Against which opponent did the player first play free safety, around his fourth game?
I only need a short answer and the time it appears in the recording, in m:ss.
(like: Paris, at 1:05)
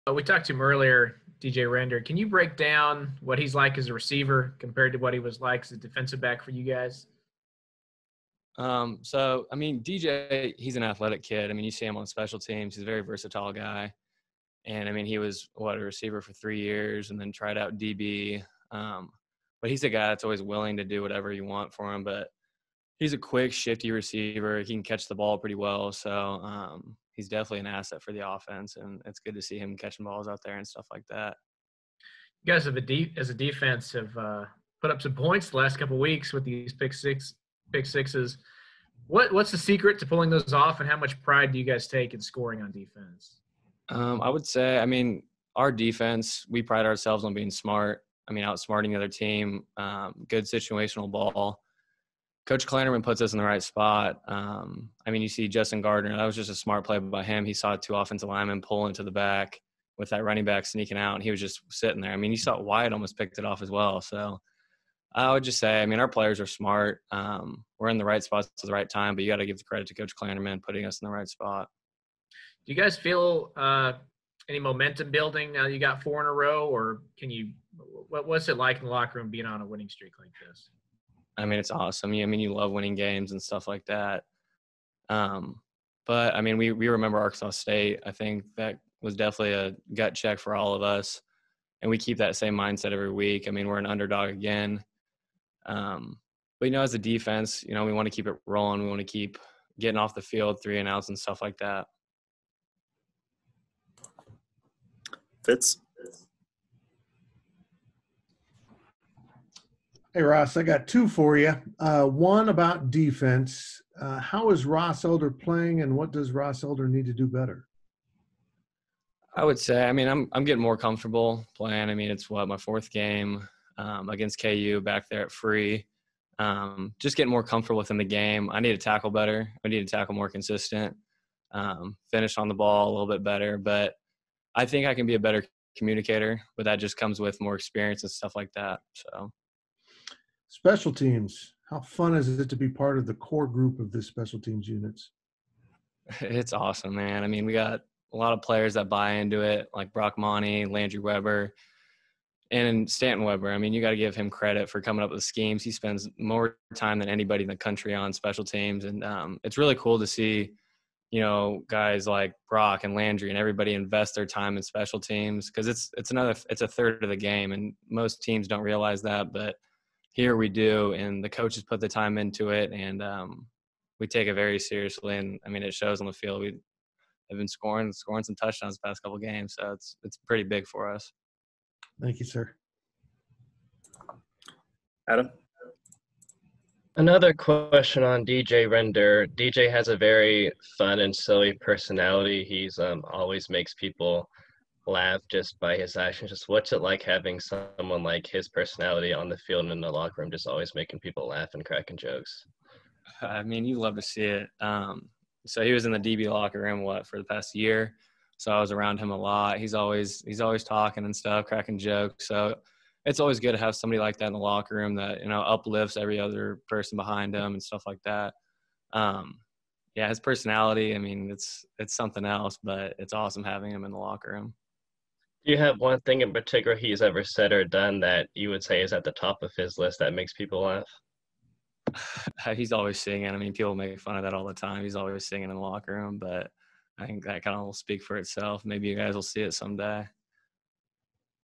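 KU, at 2:04.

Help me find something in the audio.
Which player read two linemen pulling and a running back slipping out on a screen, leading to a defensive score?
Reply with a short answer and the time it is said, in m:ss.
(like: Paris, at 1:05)
Justin Gardner, at 0:55.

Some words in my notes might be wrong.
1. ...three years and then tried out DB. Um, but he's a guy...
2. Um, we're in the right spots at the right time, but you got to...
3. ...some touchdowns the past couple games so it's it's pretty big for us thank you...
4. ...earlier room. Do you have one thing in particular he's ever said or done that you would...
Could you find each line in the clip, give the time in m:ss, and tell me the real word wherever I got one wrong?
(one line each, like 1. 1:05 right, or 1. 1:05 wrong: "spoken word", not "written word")
1. 0:16 right
2. 1:07 right
3. 2:58 right
4. 3:43 wrong: "locker", not "earlier".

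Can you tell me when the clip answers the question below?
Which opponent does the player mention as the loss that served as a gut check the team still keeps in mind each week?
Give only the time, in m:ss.
1:27.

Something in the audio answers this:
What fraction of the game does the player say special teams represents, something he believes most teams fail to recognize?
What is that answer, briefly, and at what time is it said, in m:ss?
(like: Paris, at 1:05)
a third, at 2:46.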